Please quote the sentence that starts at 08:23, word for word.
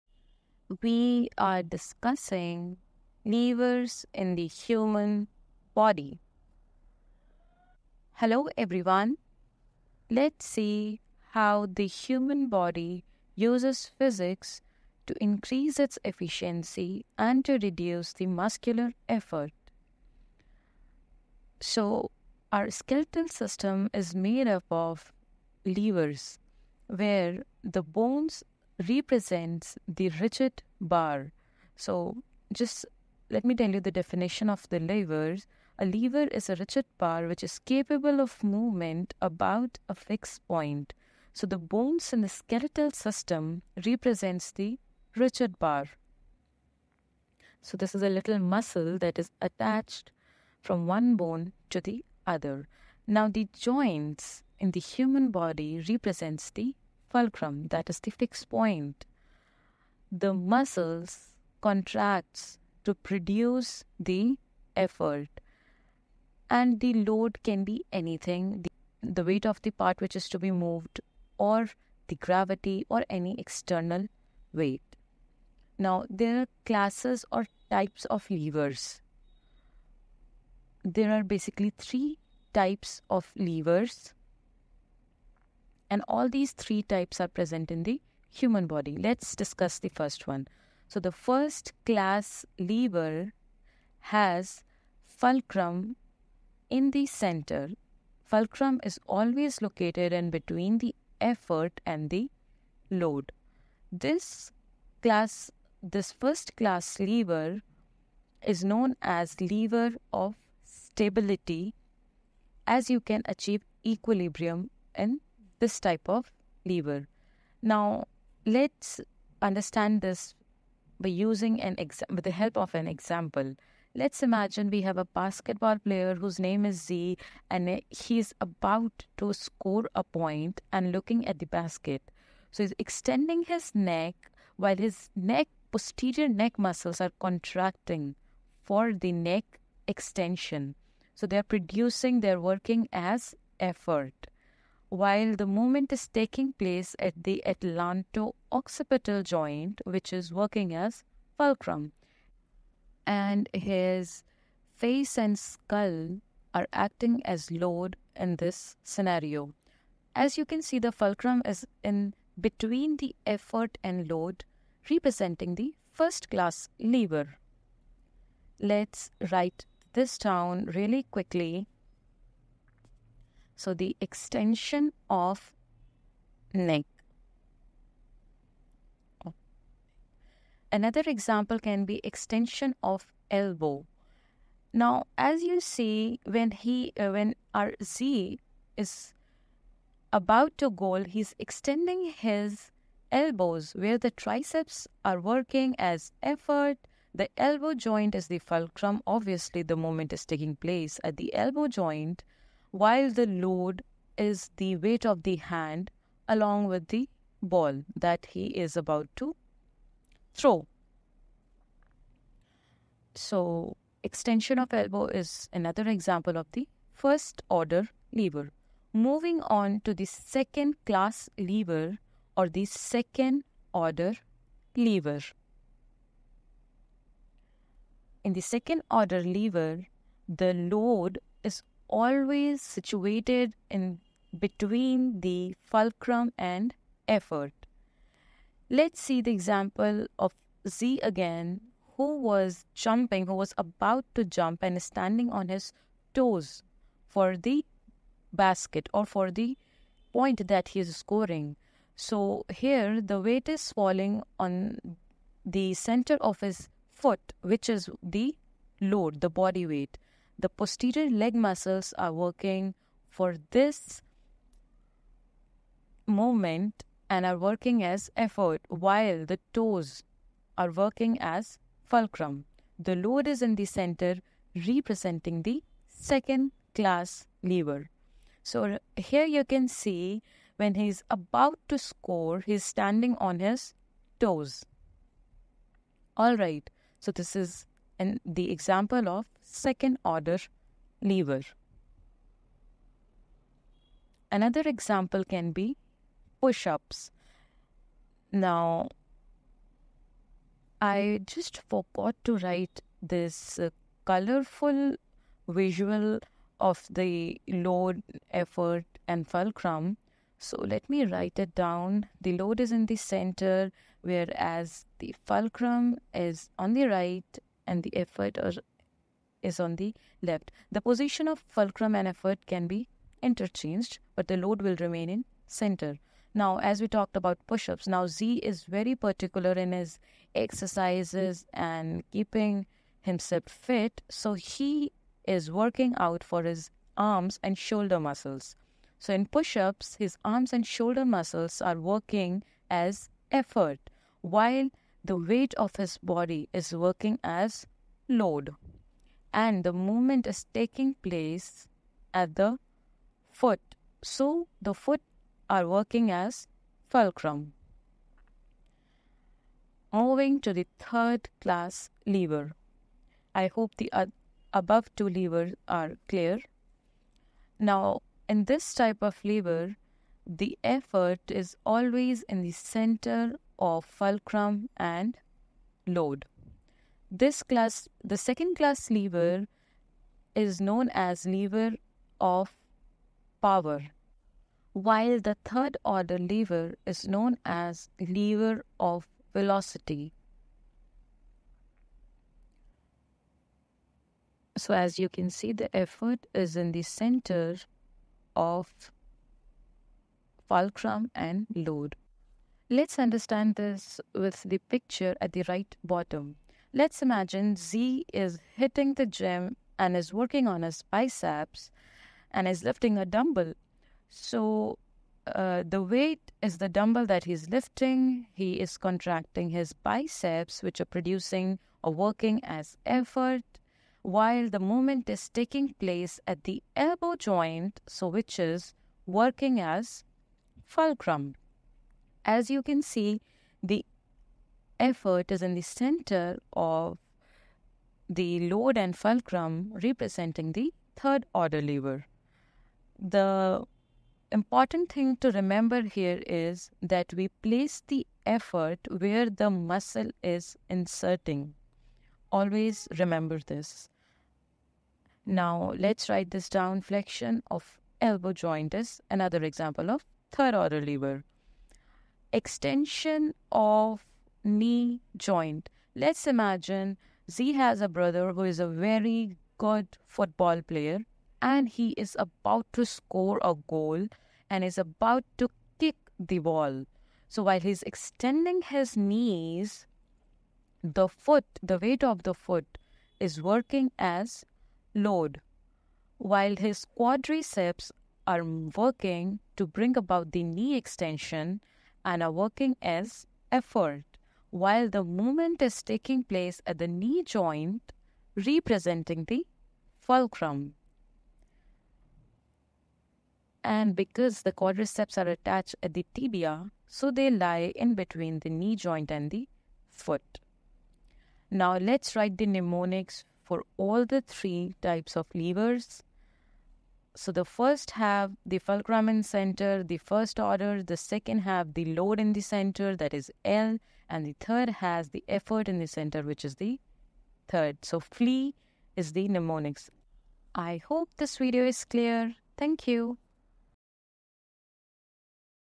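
And because the quadriceps are attached at the tibia, so they lie in between the knee joint and the foot.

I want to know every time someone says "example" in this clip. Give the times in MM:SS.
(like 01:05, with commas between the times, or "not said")
02:02, 03:01, 03:35, 03:59, 04:48, 04:54, 07:39.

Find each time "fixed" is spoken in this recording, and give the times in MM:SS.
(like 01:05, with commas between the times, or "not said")
00:39, 00:58.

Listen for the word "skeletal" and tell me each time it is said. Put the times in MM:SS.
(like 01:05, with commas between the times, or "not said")
00:22, 00:42.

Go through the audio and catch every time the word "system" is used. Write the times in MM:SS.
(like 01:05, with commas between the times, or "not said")
00:23, 00:42.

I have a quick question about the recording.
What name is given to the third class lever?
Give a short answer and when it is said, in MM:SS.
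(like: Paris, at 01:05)
Lever of velocity, at 06:27.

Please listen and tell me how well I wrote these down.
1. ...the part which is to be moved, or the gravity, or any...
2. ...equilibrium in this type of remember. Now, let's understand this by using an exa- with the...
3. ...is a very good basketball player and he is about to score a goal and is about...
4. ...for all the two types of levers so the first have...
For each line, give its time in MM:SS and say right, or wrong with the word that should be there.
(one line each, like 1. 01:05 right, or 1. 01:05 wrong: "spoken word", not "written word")
1. 01:09 right
2. 01:53 wrong: "lever", not "remember"
3. 07:48 wrong: "football", not "basketball"
4. 08:33 wrong: "three", not "two".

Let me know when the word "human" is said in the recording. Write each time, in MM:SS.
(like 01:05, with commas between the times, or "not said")
00:04, 00:11, 00:54, 01:28.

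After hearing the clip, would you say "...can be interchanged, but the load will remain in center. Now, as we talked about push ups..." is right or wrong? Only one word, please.
right.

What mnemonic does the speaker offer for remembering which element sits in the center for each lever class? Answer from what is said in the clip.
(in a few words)
FLEE.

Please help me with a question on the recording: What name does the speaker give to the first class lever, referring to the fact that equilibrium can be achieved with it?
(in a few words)
Lever of stability.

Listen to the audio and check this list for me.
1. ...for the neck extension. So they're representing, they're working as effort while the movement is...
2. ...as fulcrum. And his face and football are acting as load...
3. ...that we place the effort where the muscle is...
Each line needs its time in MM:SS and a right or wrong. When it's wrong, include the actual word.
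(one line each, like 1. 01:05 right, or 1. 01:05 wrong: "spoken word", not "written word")
1. 02:18 wrong: "producing", not "representing"
2. 02:30 wrong: "skull", not "football"
3. 07:26 right.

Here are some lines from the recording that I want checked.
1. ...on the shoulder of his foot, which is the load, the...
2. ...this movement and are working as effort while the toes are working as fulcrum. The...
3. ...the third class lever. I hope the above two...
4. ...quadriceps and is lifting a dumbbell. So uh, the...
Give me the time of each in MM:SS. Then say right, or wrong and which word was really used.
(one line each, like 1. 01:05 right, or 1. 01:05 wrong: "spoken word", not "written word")
1. 04:14 wrong: "center", not "shoulder"
2. 04:23 right
3. 06:00 right
4. 06:50 wrong: "biceps", not "quadriceps".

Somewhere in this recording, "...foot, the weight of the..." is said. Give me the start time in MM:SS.
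08:01.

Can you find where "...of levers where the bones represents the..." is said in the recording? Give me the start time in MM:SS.
00:24.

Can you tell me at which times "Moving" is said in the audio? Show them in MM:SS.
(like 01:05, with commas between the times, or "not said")
03:38, 05:59.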